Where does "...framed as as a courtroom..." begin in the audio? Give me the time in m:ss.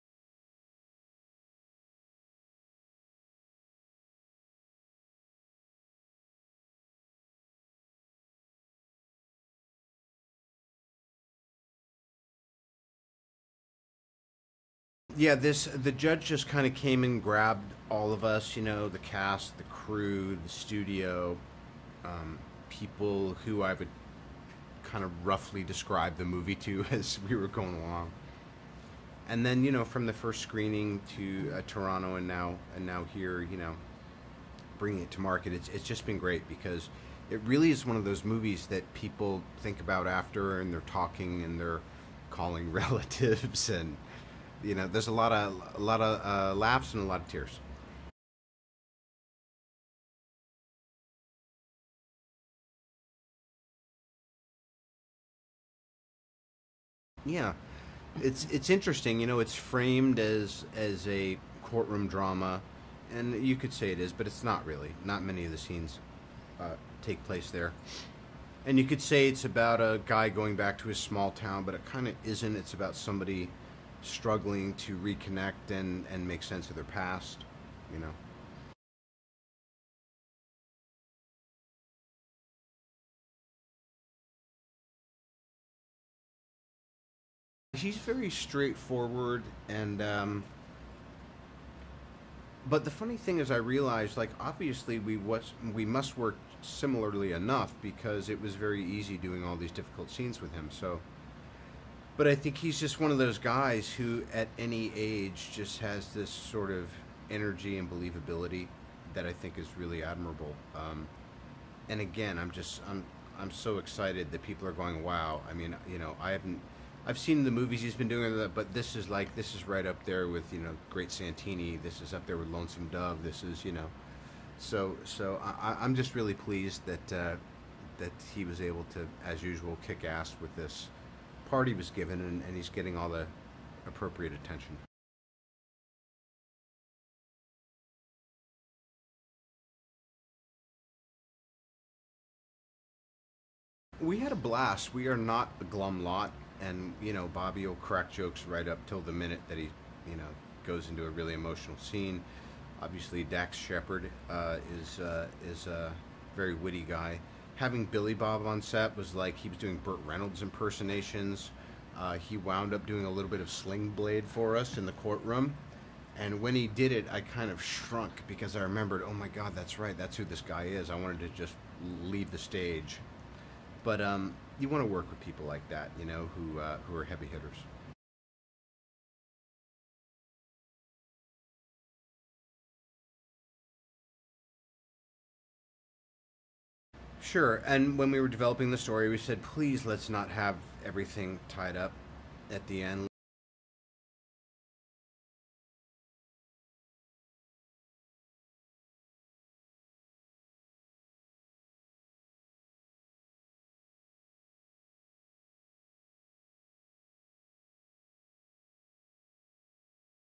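0:59.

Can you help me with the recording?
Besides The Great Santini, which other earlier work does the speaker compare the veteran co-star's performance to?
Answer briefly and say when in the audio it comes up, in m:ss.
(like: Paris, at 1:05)
Lonesome Dove, at 2:02.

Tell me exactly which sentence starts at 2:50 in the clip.
I wanted to just leave the stage.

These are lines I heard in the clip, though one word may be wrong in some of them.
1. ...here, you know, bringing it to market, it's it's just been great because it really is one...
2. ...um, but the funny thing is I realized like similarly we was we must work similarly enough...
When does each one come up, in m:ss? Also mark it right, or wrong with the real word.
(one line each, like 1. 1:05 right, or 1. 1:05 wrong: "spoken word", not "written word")
1. 0:33 right
2. 1:30 wrong: "obviously", not "similarly".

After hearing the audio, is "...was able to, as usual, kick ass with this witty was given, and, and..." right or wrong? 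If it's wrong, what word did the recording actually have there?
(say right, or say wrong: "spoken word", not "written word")
wrong: "party", not "witty".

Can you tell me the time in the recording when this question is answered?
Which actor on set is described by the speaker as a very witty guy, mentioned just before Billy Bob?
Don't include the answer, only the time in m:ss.
2:33.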